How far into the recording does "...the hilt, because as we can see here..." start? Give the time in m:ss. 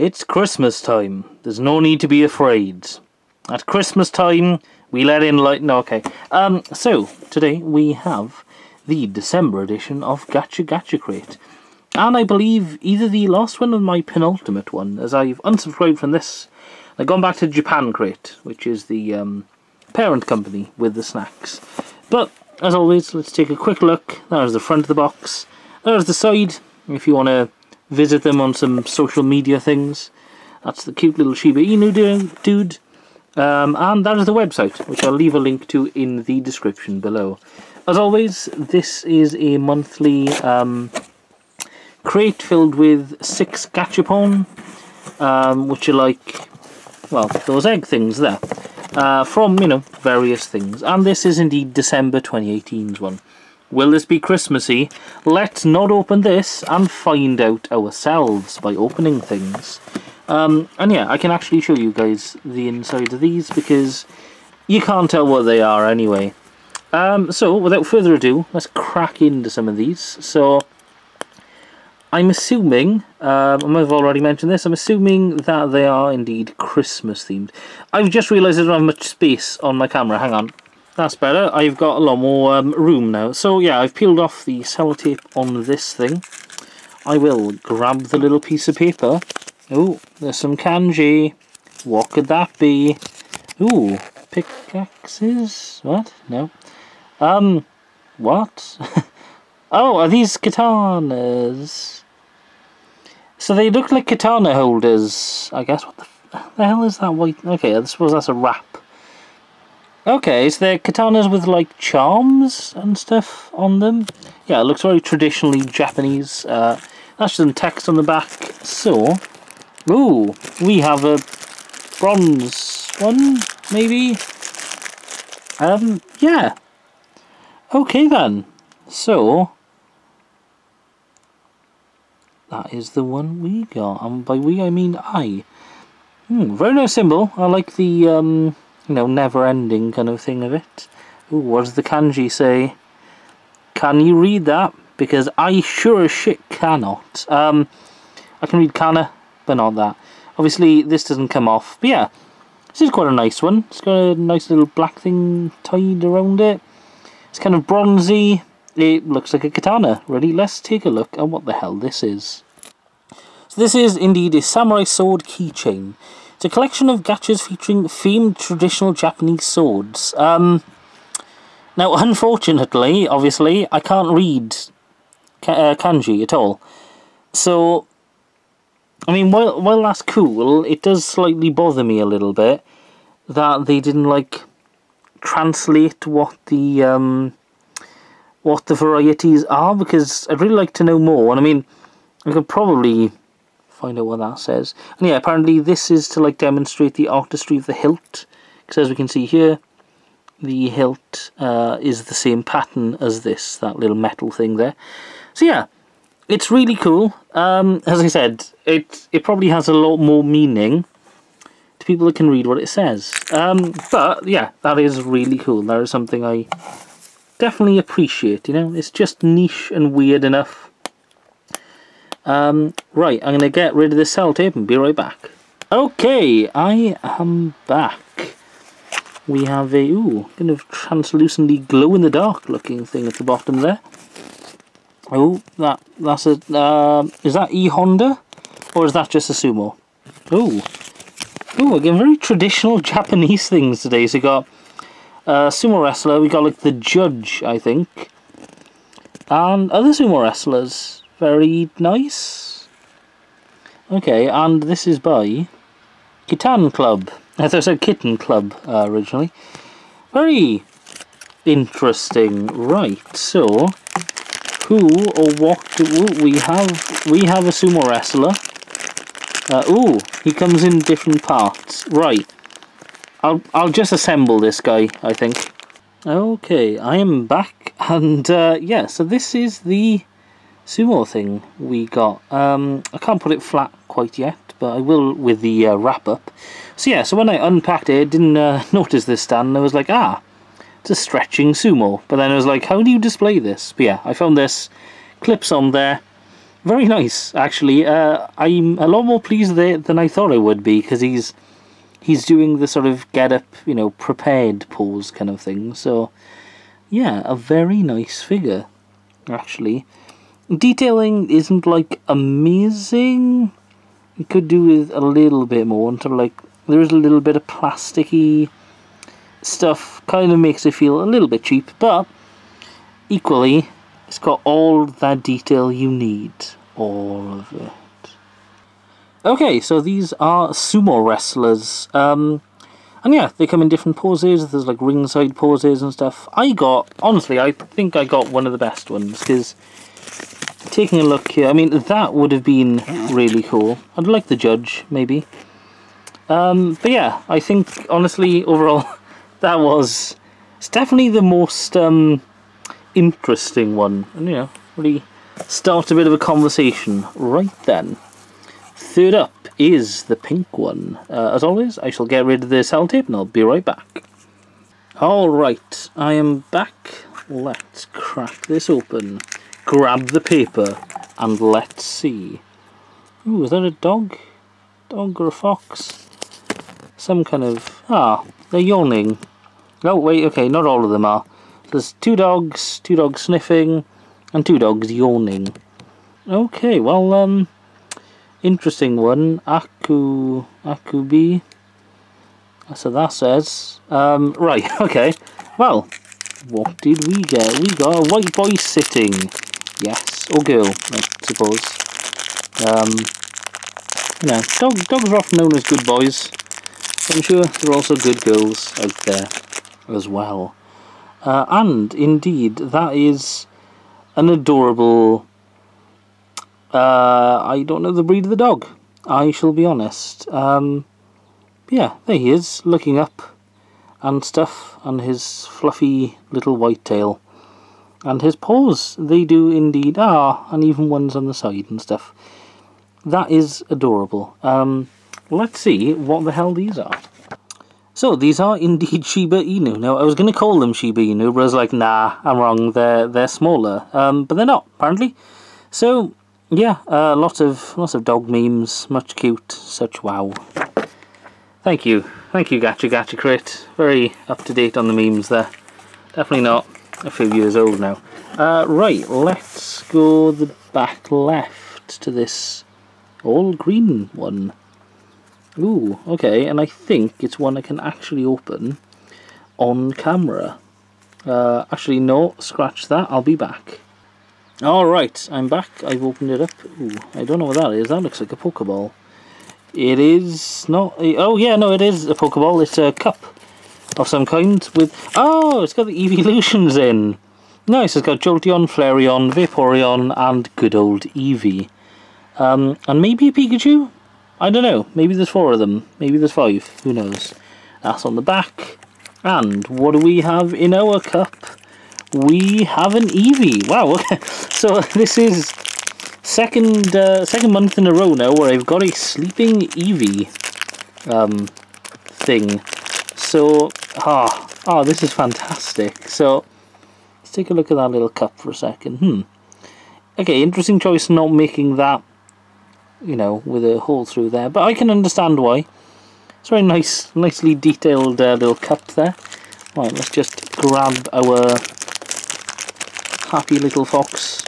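3:17.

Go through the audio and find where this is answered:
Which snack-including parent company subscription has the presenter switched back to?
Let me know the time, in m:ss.
0:17.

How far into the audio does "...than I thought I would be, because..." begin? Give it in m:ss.
4:59.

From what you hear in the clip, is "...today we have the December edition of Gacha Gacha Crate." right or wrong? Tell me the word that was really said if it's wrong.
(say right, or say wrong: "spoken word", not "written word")
right.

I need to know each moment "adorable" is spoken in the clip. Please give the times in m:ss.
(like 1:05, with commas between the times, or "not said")
6:54, 7:13.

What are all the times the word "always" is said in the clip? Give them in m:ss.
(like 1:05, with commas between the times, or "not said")
0:22, 0:37, 6:01.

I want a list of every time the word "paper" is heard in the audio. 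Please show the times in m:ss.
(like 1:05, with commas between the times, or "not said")
1:28, 6:10.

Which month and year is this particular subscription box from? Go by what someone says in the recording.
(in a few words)
December 2018.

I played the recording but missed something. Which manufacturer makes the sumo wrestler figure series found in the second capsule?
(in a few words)
Kitan Club.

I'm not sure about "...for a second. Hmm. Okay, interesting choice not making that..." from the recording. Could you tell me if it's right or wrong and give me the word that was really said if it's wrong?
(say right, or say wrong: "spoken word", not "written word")
right.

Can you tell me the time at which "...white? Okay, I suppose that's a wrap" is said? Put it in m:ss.
1:47.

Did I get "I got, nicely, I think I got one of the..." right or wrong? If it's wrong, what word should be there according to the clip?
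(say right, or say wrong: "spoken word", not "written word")
wrong: "honestly", not "nicely".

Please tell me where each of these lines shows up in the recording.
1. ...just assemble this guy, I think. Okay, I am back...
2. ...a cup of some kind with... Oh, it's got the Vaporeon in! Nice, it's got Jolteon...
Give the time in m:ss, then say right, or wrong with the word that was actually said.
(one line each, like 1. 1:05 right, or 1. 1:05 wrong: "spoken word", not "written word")
1. 4:33 right
2. 8:02 wrong: "Eeveelutions", not "Vaporeon".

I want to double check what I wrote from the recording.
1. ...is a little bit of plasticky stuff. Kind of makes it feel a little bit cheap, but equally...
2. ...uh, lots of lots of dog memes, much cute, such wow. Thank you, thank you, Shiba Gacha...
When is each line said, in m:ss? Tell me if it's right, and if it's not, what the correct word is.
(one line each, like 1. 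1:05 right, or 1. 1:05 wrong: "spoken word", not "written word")
1. 5:16 right
2. 7:26 wrong: "Gacha", not "Shiba".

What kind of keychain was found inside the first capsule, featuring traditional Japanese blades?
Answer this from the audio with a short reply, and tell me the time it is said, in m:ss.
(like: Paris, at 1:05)
Samurai sword keychain, at 2:44.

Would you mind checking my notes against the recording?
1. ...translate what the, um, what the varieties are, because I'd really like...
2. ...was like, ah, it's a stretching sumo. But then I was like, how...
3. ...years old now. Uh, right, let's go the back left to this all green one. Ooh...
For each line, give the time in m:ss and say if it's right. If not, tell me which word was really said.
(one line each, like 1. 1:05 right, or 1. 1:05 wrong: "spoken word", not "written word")
1. 3:05 right
2. 4:49 right
3. 7:37 right.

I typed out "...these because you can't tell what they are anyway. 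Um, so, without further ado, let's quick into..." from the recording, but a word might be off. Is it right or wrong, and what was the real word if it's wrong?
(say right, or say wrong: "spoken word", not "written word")
wrong: "crack", not "quick".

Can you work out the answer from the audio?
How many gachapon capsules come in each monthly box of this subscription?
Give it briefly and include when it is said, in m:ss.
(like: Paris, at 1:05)
6, at 0:43.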